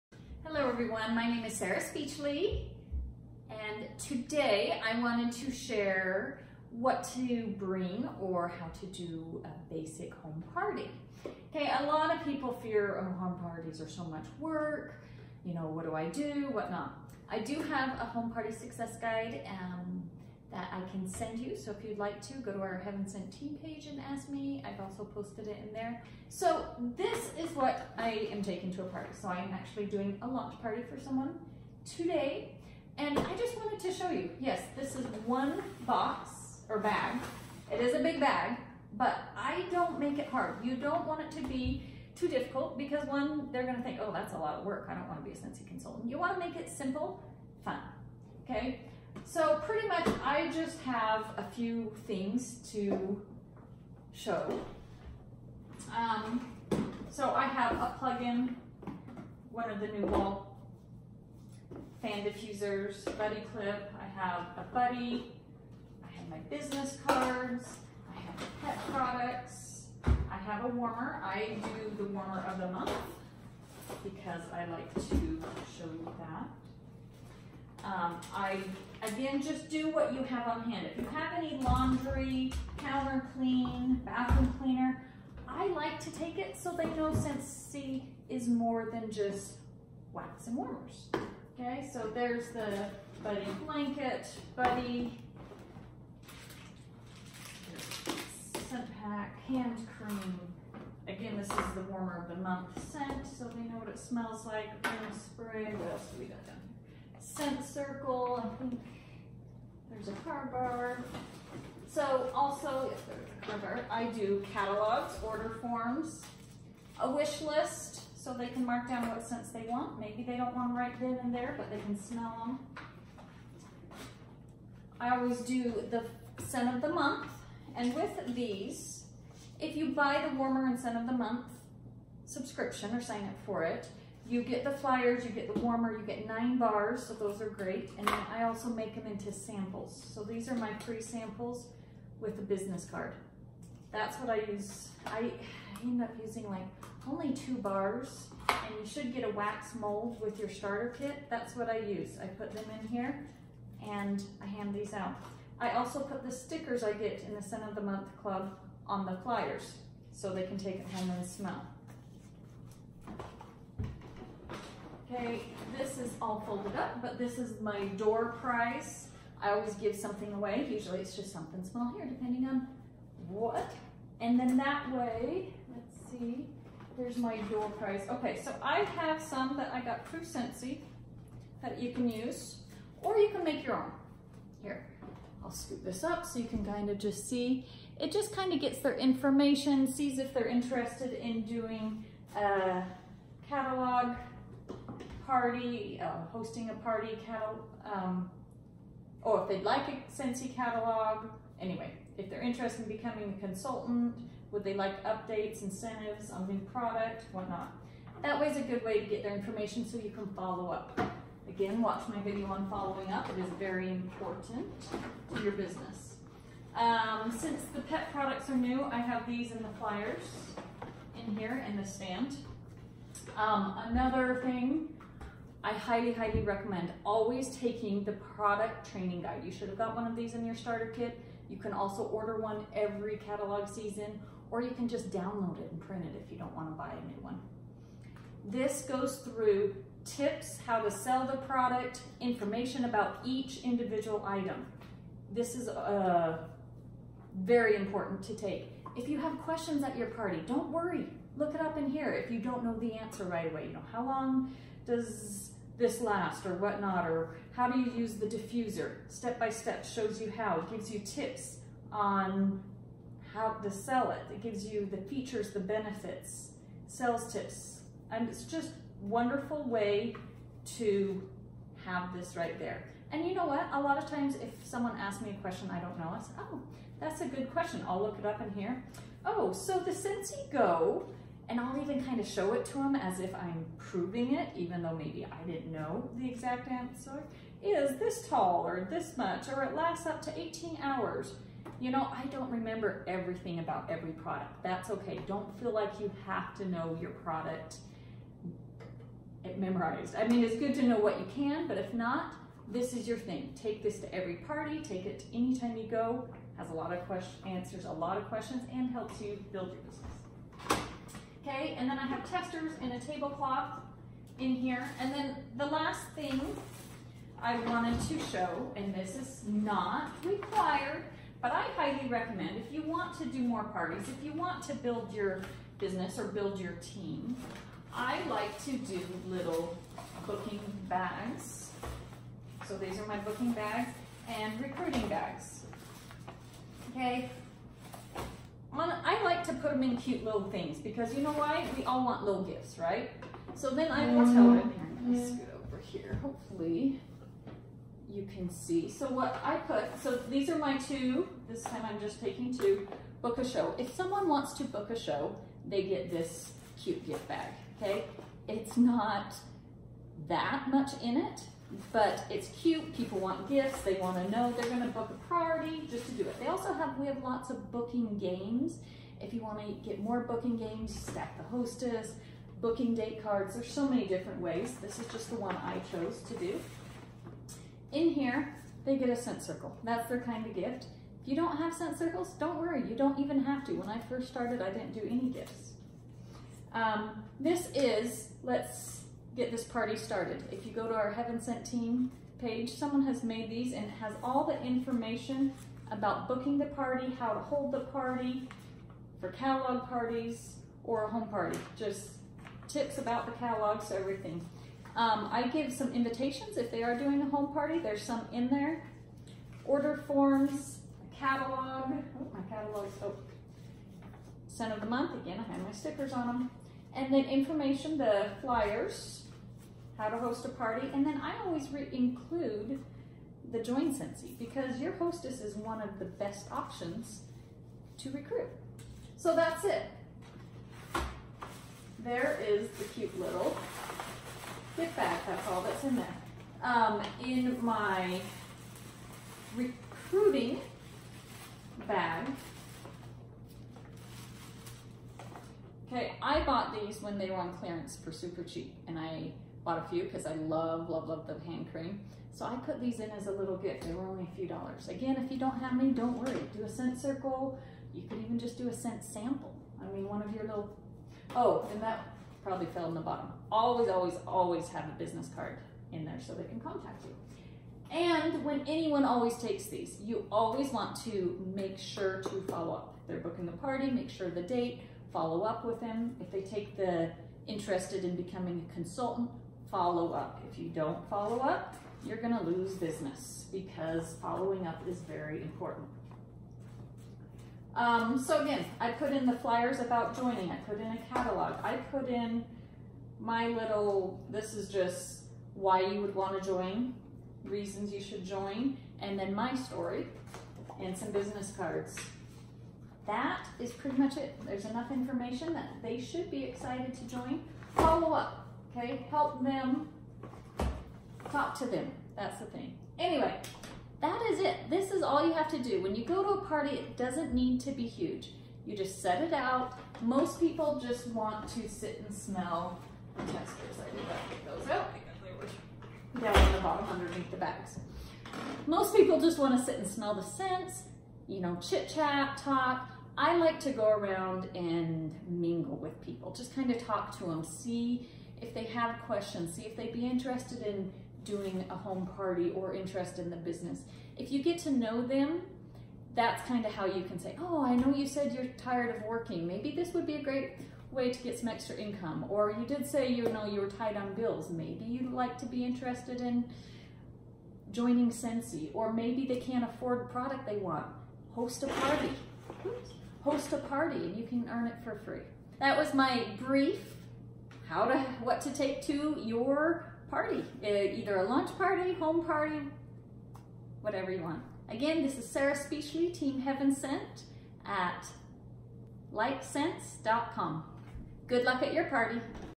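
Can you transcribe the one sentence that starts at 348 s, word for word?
So what I put, so these are my two, this time I'm just taking two, book a show.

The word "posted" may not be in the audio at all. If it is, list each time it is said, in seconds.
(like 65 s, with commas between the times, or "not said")
25 s.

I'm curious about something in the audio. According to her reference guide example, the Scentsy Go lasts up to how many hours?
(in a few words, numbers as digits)
18.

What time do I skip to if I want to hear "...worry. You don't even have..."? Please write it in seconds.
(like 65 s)
382 s.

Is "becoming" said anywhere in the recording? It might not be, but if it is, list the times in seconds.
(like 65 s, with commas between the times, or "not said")
202 s, 478 s.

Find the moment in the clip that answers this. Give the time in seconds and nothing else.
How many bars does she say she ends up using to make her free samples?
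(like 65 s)
147 s.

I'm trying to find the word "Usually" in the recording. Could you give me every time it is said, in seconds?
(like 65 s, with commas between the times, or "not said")
170 s.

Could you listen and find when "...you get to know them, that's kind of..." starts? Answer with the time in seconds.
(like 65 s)
544 s.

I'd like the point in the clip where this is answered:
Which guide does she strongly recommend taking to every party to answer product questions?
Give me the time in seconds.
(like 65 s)
228 s.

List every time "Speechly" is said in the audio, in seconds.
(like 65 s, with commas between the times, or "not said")
1 s, 575 s.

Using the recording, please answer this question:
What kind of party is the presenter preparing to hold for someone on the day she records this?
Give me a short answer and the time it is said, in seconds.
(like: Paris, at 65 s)
launch party, at 30 s.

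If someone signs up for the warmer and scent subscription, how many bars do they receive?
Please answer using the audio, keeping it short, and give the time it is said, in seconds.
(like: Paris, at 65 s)
9, at 136 s.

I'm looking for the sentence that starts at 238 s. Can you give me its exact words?
This goes through tips, how to sell the product, information about each individual item.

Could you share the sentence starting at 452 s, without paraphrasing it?
So I put these in as a little gift.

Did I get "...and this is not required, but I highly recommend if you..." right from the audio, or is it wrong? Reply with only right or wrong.
right.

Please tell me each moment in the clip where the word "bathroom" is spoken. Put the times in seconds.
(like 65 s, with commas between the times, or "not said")
84 s.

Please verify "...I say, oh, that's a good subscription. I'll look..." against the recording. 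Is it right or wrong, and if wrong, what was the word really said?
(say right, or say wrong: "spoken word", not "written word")
wrong: "question", not "subscription".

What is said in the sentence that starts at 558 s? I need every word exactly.
Or maybe they can't afford the product they want.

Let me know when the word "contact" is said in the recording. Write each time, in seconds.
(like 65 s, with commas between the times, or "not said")
466 s.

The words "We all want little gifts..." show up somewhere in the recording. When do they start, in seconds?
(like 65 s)
341 s.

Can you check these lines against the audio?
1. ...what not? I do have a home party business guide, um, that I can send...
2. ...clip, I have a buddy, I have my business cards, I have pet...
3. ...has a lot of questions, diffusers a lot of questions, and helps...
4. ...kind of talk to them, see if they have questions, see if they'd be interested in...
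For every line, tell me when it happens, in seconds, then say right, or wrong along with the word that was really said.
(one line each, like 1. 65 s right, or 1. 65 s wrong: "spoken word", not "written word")
1. 16 s wrong: "success", not "business"
2. 63 s right
3. 306 s wrong: "answers", not "diffusers"
4. 536 s right.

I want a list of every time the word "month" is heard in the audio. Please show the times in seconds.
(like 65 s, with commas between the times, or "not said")
72 s, 102 s, 126 s, 131 s, 157 s, 414 s.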